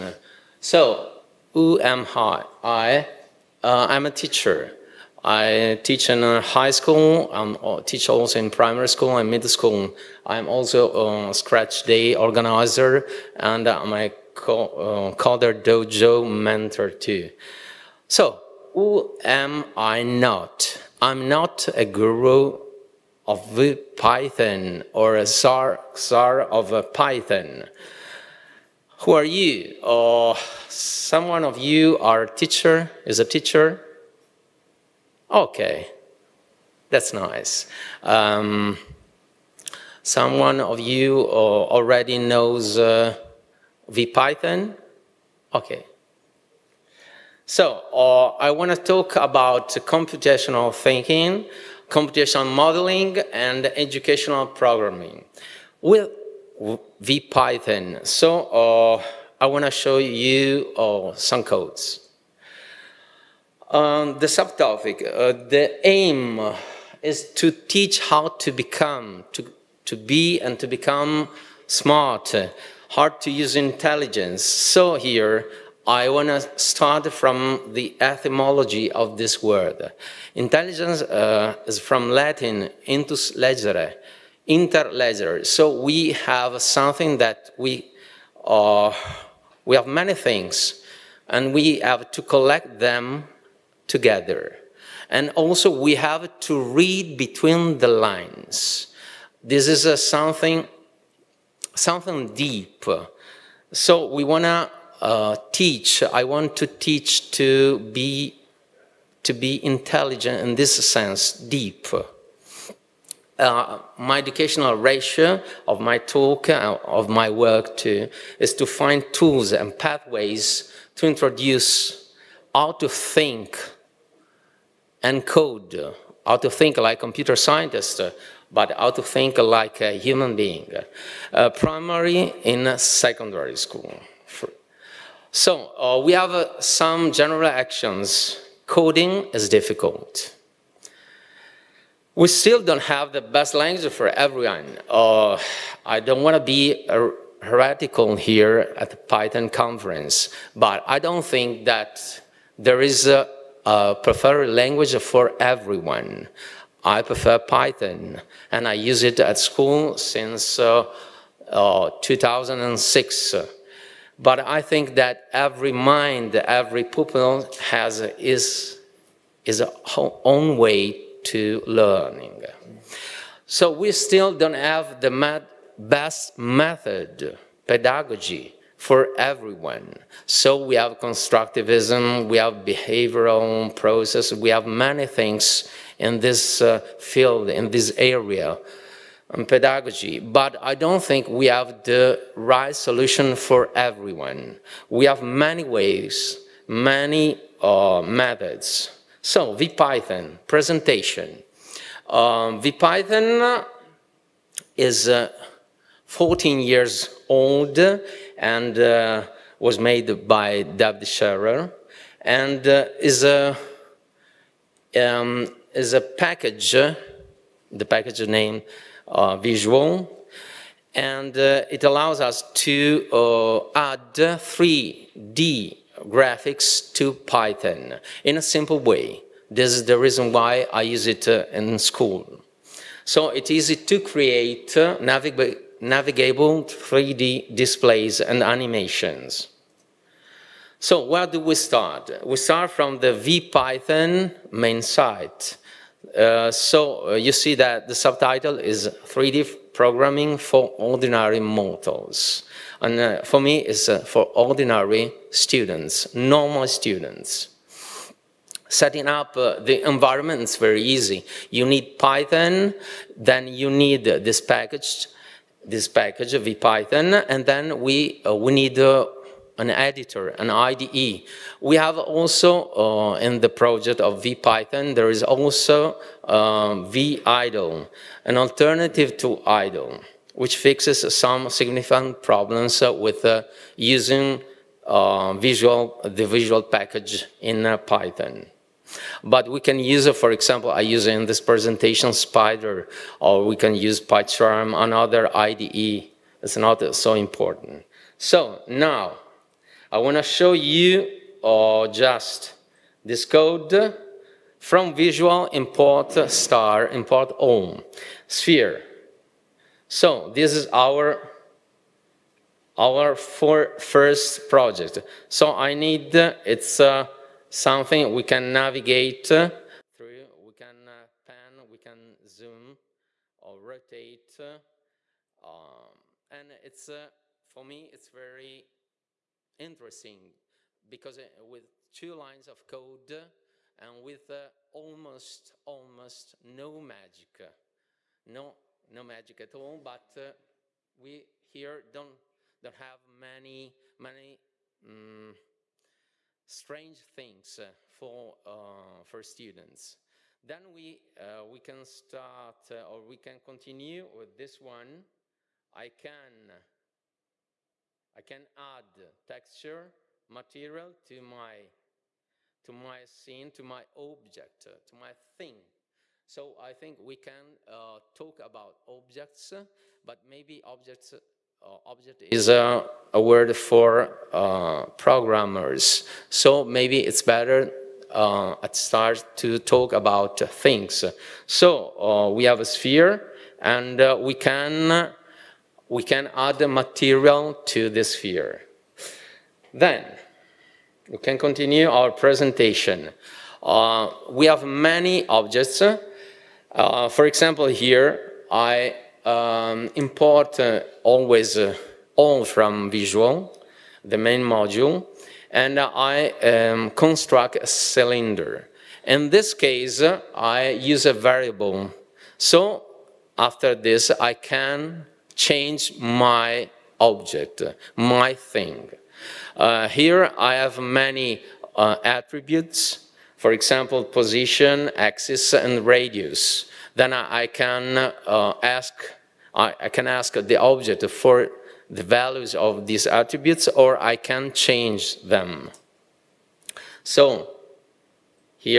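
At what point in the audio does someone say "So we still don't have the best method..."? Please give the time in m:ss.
2:53.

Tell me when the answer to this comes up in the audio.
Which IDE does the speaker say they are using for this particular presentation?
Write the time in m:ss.
4:52.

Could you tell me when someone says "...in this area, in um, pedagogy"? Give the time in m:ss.
3:07.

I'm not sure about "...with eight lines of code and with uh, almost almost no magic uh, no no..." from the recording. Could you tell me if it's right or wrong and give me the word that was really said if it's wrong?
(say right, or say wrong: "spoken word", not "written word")
wrong: "two", not "eight".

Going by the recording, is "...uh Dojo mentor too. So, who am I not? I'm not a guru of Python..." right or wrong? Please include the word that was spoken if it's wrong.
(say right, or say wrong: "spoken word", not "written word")
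right.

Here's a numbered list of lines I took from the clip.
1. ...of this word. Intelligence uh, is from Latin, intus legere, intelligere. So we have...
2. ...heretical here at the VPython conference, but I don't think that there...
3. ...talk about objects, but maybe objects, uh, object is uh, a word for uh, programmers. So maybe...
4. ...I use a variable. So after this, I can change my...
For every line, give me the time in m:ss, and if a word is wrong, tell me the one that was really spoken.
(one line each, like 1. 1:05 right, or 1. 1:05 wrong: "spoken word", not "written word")
1. 1:18 right
2. 2:27 wrong: "Python", not "VPython"
3. 6:08 right
4. 6:50 right.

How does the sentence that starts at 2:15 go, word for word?
So uh, we have some general actions.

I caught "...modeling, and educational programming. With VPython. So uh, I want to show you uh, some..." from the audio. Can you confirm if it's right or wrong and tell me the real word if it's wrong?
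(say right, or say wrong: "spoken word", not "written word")
right.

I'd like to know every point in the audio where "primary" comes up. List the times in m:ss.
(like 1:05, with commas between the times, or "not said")
0:08, 2:11.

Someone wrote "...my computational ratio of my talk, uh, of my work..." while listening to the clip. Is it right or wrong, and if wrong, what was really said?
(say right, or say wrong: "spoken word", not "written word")
wrong: "educational", not "computational".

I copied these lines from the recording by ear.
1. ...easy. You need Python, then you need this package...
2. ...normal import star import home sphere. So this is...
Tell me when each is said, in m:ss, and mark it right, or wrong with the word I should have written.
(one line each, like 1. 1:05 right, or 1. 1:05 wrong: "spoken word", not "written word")
1. 4:20 right
2. 5:04 wrong: "visual", not "normal".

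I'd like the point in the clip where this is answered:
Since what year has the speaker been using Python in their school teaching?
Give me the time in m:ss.
2:42.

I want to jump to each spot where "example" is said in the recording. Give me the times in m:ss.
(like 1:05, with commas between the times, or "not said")
4:50, 6:37, 7:03.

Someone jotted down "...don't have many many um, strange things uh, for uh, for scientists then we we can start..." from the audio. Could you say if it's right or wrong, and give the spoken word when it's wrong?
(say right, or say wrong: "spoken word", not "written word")
wrong: "students", not "scientists".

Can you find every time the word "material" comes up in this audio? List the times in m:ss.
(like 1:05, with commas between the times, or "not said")
6:00, 6:26.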